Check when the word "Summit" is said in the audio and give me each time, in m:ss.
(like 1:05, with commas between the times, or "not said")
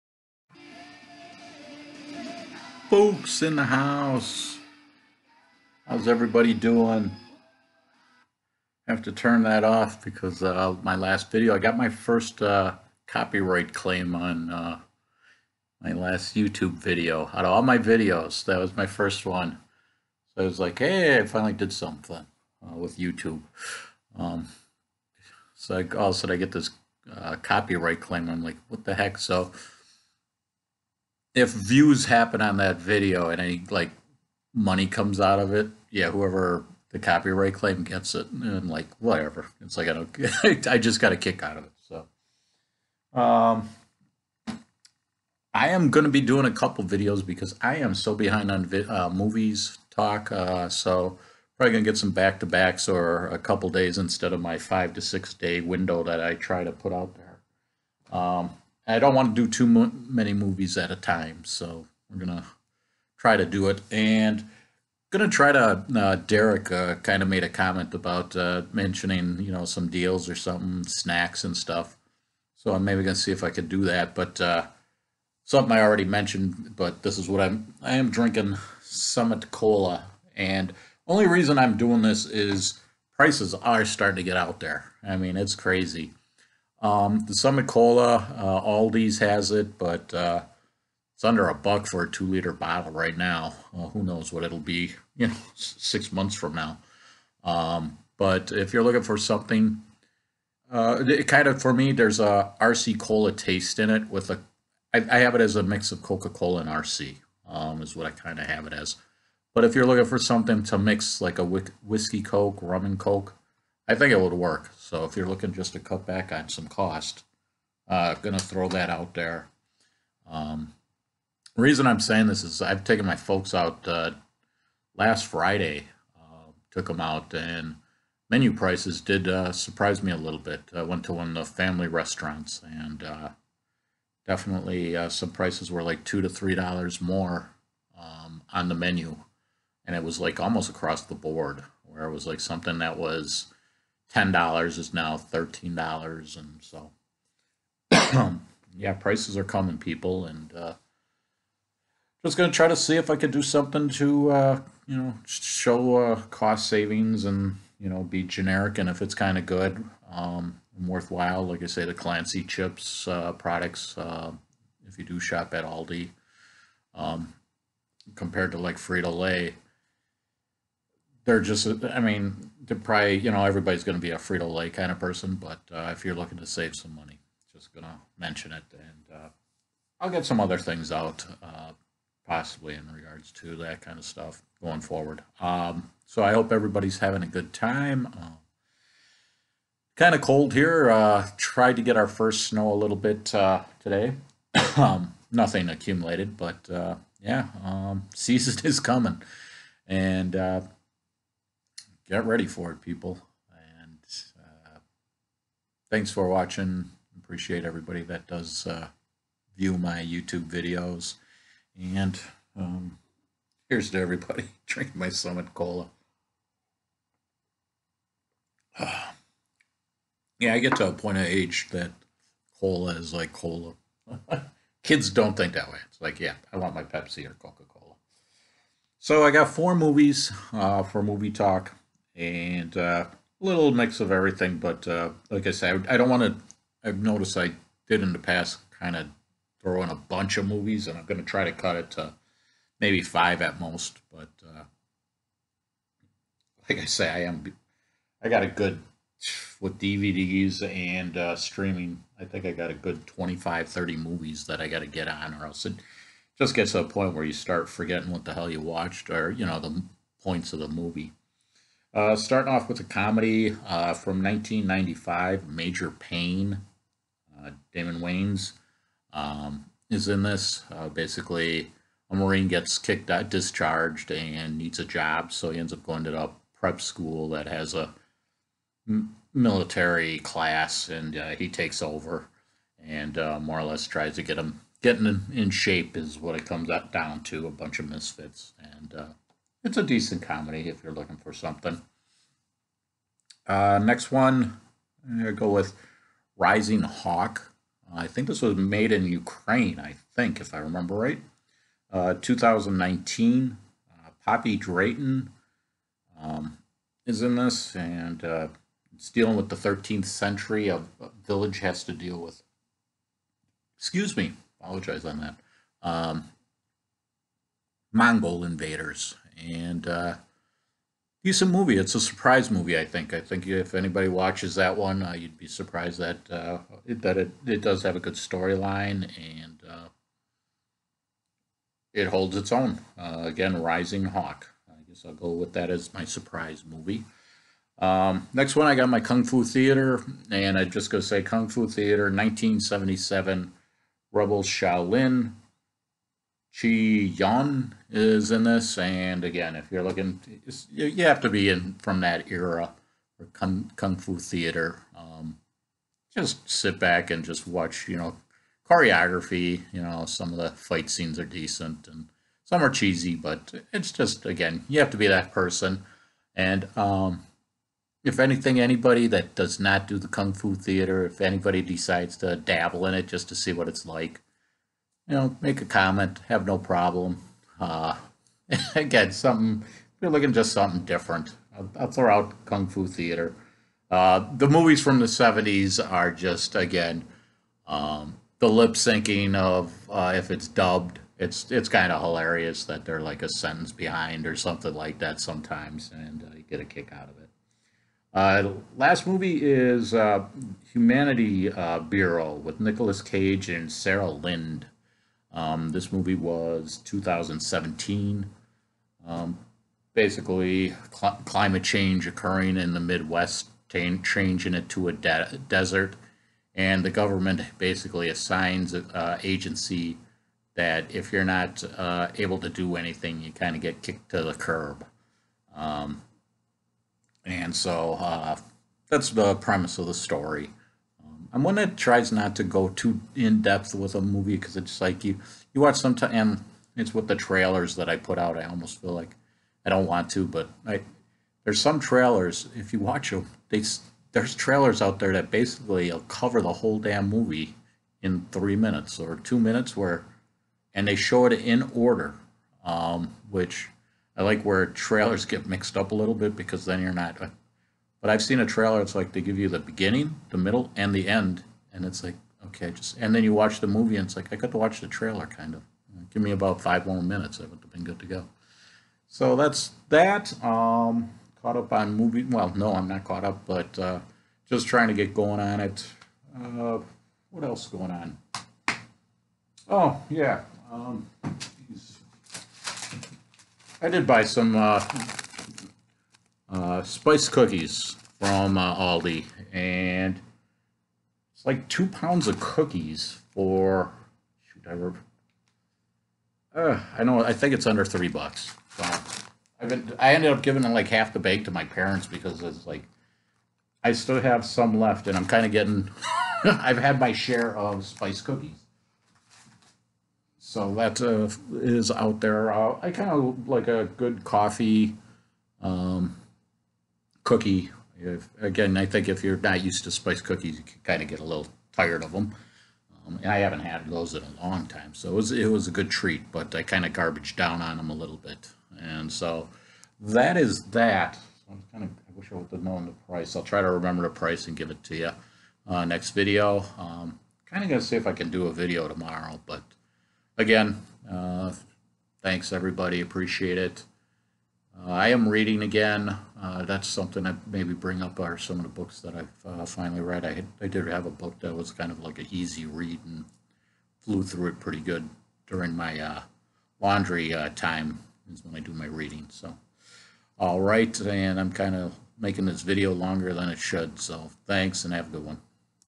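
1:18, 1:27, 3:35.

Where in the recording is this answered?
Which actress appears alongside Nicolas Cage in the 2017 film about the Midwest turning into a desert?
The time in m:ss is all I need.
6:43.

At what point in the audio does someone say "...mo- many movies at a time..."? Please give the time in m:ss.
0:59.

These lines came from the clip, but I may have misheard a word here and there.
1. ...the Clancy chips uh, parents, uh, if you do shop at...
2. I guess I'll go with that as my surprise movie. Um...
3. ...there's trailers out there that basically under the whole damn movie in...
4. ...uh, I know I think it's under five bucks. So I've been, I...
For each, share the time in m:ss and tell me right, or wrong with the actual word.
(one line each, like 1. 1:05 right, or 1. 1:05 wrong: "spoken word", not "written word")
1. 2:41 wrong: "products", not "parents"
2. 5:34 right
3. 7:24 wrong: "cover", not "under"
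4. 8:16 wrong: "three", not "five".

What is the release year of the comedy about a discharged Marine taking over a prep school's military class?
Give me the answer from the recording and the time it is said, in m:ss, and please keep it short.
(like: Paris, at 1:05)
1995, at 4:24.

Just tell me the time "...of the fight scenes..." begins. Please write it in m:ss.
6:00.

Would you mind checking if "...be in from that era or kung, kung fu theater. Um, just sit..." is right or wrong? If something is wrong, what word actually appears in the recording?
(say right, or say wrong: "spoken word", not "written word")
right.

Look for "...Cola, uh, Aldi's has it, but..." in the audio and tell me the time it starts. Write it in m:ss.
1:27.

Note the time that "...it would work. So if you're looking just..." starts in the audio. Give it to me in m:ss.
1:54.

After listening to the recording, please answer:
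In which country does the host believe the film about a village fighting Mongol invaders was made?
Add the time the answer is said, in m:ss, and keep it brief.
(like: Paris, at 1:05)
Ukraine, at 4:59.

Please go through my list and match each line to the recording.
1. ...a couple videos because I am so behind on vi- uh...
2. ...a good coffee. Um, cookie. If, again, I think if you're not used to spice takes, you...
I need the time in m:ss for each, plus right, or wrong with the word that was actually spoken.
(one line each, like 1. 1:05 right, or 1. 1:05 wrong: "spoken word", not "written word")
1. 0:46 right
2. 8:33 wrong: "cookies", not "takes".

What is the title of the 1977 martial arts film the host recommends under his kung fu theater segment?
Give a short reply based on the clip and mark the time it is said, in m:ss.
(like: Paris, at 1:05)
Rebel Shaolin, at 5:44.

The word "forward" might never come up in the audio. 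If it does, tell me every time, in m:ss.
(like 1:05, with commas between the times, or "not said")
3:04.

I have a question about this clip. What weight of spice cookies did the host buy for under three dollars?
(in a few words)
2 pounds.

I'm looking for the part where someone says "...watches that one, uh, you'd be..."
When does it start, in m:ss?
5:24.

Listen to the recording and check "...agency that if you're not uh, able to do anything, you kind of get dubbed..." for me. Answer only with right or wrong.
wrong.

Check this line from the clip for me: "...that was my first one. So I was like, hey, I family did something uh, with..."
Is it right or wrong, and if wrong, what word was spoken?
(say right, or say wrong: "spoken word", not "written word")
wrong: "finally", not "family".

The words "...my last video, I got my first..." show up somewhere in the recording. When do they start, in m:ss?
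0:10.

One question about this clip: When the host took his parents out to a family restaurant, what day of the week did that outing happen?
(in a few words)
Friday.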